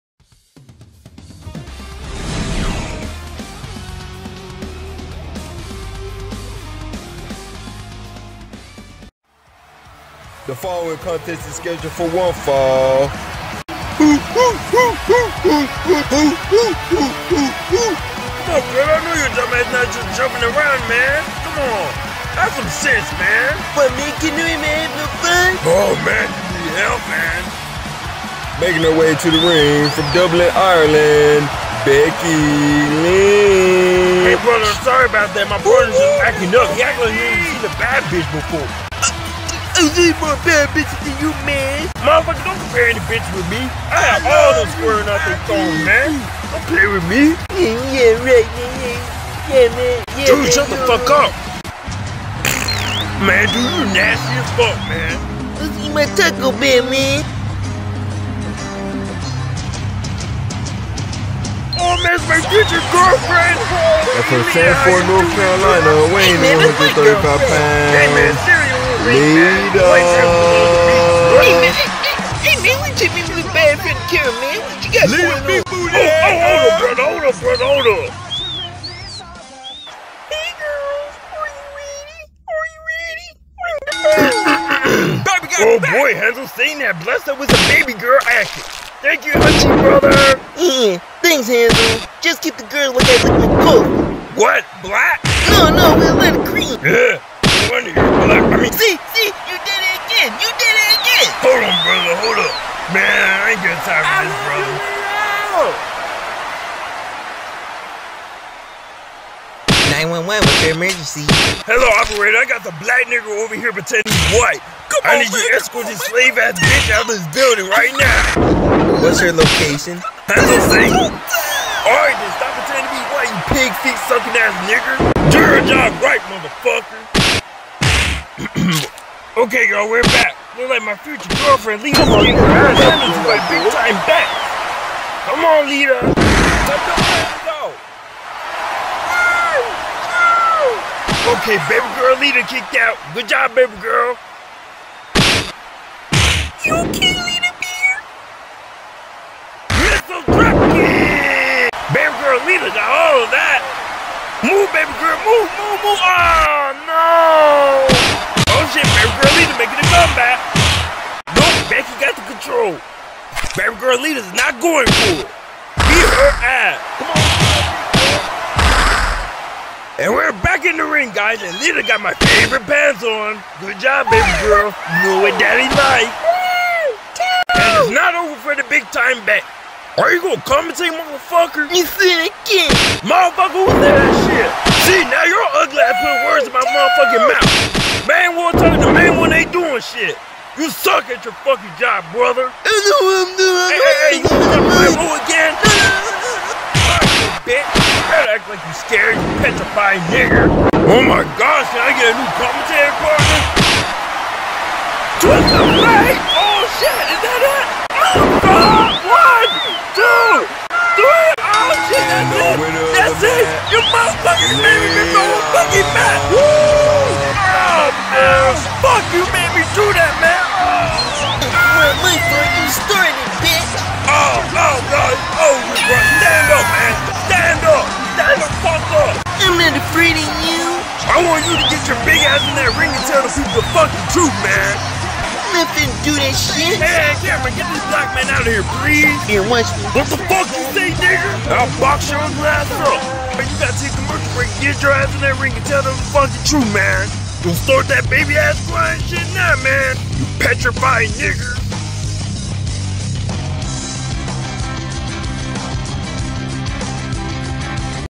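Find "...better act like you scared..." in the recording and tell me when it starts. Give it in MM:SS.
03:18.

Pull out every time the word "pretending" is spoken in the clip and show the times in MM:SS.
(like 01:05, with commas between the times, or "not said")
01:53, 02:02.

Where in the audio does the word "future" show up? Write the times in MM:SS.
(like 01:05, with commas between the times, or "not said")
01:02, 02:10.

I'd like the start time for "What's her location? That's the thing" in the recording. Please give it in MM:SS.
01:59.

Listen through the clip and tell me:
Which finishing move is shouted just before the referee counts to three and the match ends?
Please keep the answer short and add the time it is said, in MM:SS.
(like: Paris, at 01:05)
Twist of Fate, at 03:25.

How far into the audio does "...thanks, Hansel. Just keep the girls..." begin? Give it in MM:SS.
01:31.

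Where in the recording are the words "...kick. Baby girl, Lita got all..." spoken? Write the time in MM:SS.
02:30.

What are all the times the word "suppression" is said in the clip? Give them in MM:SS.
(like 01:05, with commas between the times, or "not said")
not said.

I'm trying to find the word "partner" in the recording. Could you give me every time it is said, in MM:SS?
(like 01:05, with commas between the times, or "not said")
03:23.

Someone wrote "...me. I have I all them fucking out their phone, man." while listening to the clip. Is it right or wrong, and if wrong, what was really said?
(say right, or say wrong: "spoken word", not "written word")
wrong: "squaring", not "fucking".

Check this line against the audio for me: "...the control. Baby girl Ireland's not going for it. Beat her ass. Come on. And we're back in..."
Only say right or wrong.
wrong.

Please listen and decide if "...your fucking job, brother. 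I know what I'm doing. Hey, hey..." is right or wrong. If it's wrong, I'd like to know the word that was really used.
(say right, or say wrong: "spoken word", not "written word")
right.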